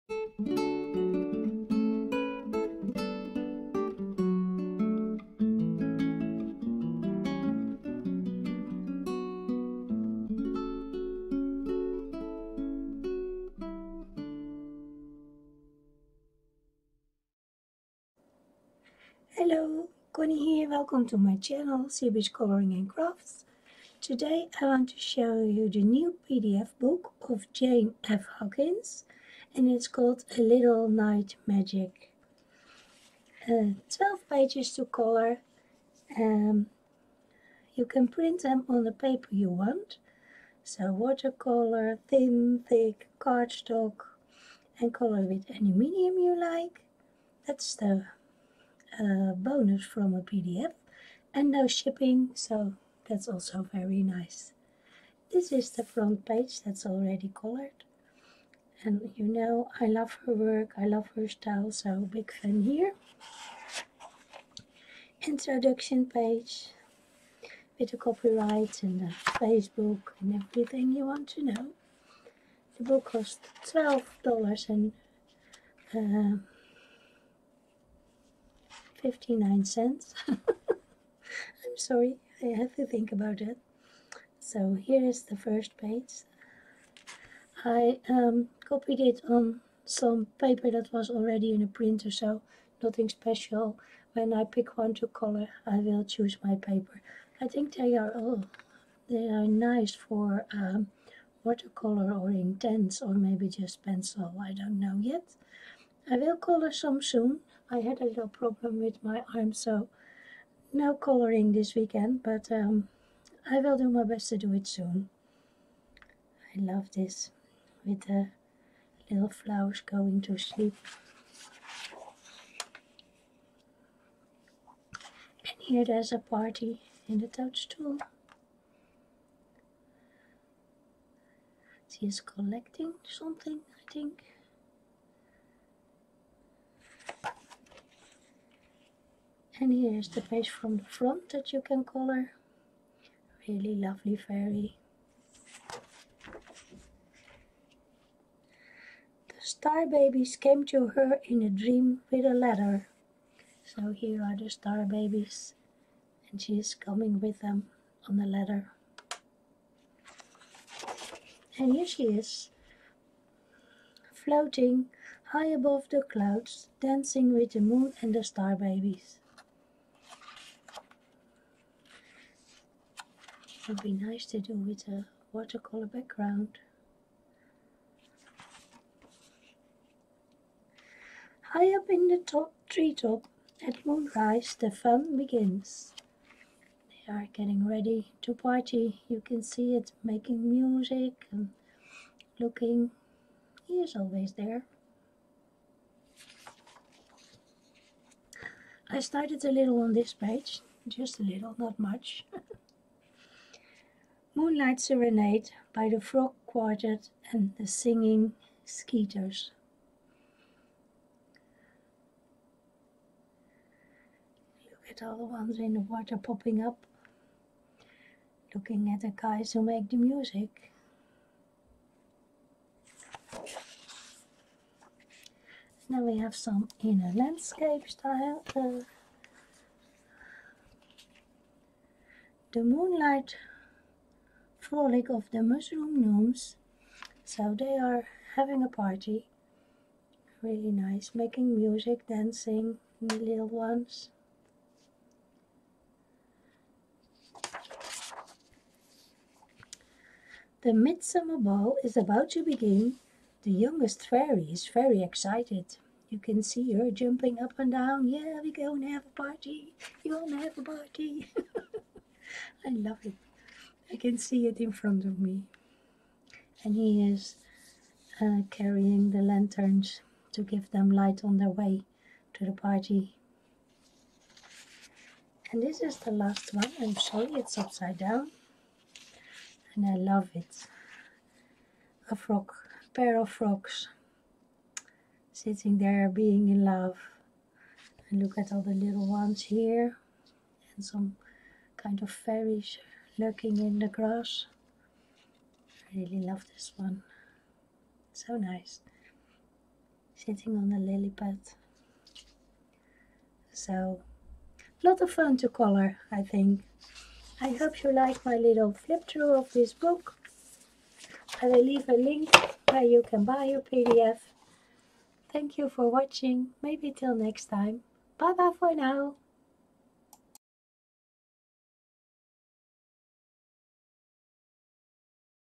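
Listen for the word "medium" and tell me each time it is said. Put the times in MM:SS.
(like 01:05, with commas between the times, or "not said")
00:45.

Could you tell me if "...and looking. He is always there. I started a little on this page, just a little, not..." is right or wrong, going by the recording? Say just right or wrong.
right.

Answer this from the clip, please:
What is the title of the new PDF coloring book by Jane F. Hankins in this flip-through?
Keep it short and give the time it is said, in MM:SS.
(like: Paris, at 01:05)
A Little Night Magic, at 00:30.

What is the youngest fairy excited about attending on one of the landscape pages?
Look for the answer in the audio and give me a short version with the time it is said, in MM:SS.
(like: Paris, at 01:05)
The midsummer ball, at 04:10.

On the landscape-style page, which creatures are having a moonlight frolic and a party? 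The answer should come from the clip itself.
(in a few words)
The mushroom gnomes.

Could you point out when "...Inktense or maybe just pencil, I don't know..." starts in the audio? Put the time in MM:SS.
01:42.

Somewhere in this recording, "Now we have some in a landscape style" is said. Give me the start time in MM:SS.
03:45.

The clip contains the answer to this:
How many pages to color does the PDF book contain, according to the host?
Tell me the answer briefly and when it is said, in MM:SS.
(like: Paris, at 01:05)
12, at 00:33.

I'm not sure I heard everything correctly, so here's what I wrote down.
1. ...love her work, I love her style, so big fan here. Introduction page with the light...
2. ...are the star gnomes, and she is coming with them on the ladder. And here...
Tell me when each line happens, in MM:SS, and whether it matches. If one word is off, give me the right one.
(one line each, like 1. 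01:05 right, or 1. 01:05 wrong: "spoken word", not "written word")
1. 00:59 wrong: "copyright", not "light"
2. 02:34 wrong: "babies", not "gnomes".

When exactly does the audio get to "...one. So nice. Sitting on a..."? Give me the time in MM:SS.
04:56.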